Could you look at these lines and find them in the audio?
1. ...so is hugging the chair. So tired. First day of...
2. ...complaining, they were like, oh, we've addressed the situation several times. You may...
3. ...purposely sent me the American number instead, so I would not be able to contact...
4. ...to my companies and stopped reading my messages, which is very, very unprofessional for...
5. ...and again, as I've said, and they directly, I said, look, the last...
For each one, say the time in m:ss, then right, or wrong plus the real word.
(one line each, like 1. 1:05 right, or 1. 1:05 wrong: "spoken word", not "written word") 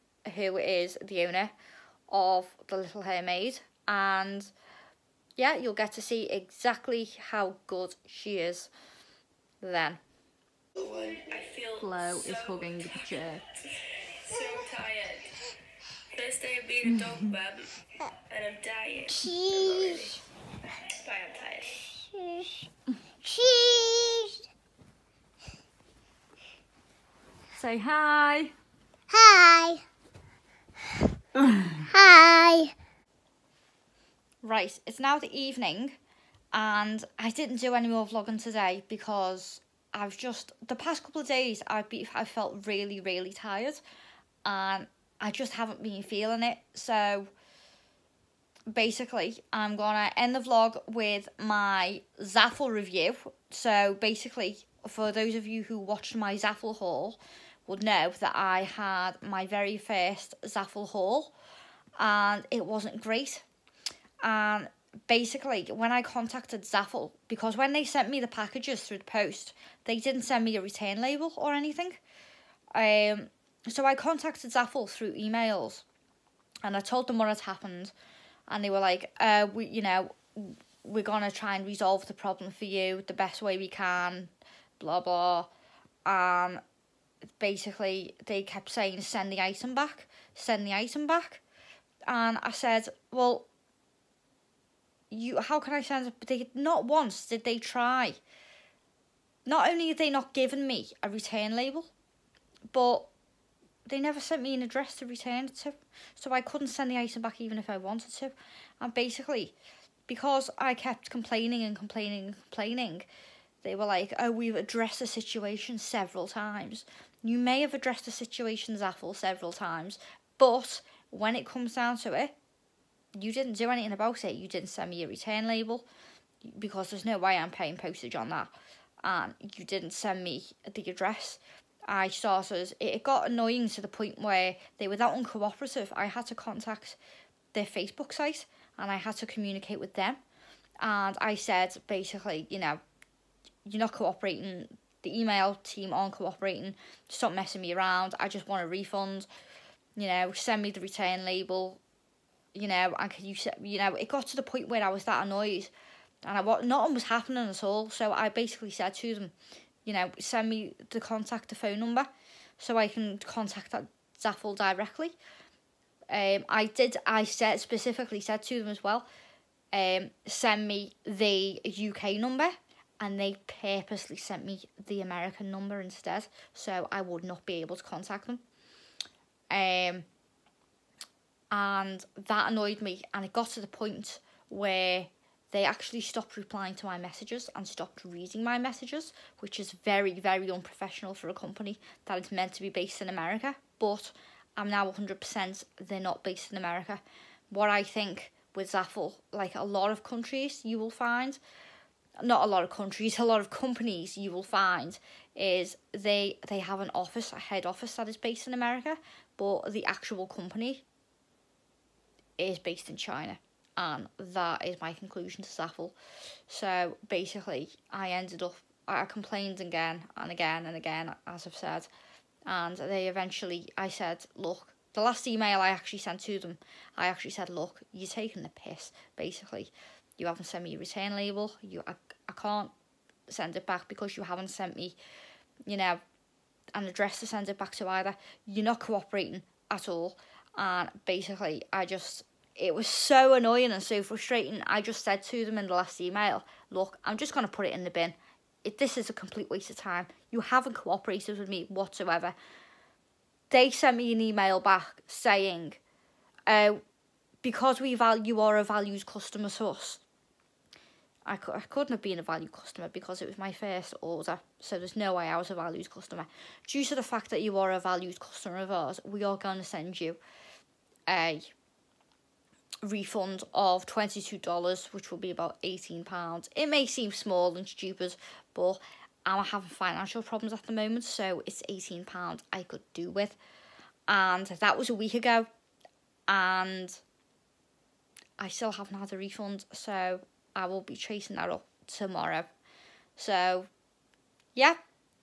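1. 0:12 right
2. 1:52 right
3. 2:53 right
4. 3:06 wrong: "messages", not "companies"
5. 3:40 wrong: "eventually", not "directly".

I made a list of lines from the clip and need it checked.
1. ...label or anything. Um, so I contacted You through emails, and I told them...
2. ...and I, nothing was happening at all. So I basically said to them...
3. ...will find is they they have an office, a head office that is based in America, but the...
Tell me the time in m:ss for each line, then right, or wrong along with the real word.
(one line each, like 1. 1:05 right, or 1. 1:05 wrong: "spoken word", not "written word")
1. 1:11 wrong: "ZAFUL", not "You"
2. 2:36 right
3. 3:24 right.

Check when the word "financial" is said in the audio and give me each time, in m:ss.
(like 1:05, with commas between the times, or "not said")
4:39.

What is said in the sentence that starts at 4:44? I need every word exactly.
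And that was a week ago, and I still haven't had a refund, so I will be chasing that up tomorrow.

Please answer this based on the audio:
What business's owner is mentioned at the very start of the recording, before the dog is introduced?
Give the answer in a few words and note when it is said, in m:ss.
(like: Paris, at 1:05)
The Little Hairmaid, at 0:02.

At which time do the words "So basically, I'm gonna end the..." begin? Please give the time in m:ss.
0:46.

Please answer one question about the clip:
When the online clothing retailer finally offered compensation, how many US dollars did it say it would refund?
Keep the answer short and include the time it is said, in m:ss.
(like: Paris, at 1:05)
$22, at 4:33.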